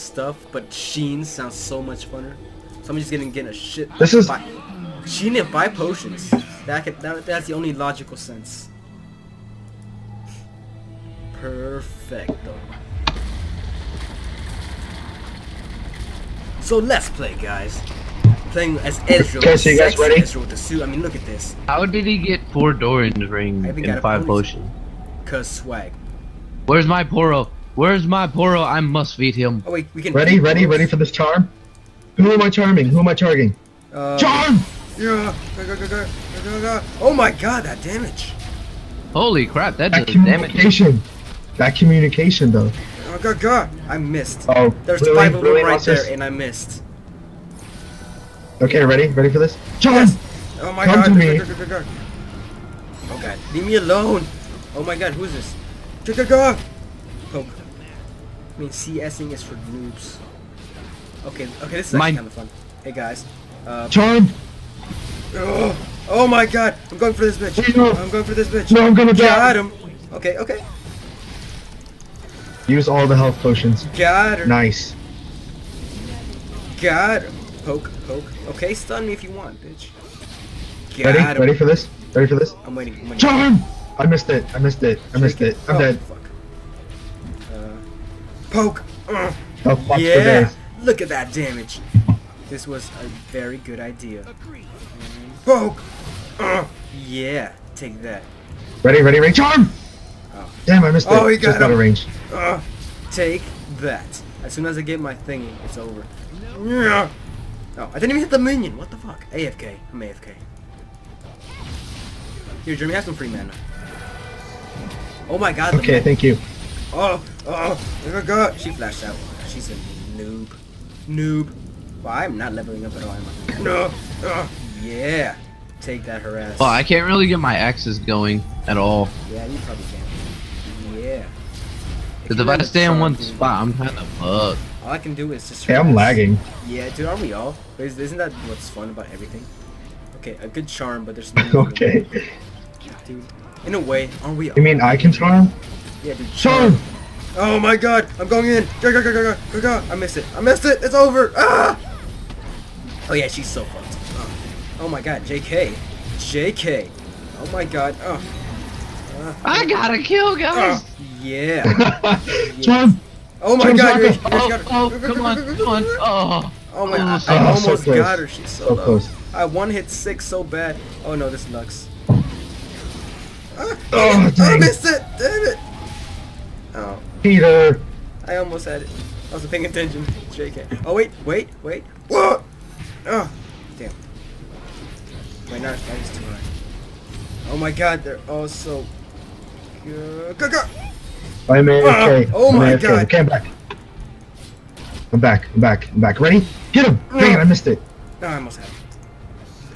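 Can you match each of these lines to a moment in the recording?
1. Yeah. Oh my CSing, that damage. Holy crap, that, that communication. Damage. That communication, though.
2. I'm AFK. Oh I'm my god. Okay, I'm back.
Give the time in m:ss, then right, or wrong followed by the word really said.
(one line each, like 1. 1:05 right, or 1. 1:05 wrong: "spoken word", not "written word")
1. 0:34 wrong: "God", not "CSing"
2. 3:11 right.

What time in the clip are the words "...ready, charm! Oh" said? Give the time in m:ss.
1:39.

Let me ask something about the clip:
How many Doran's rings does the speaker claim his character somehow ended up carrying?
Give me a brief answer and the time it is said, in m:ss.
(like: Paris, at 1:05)
4, at 0:22.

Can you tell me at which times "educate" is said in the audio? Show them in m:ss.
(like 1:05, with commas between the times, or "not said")
not said.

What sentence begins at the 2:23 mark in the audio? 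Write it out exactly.
Dude, in a way, aren't we?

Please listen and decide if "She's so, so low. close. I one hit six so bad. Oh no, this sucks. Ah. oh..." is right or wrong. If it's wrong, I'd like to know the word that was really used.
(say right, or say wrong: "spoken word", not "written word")
right.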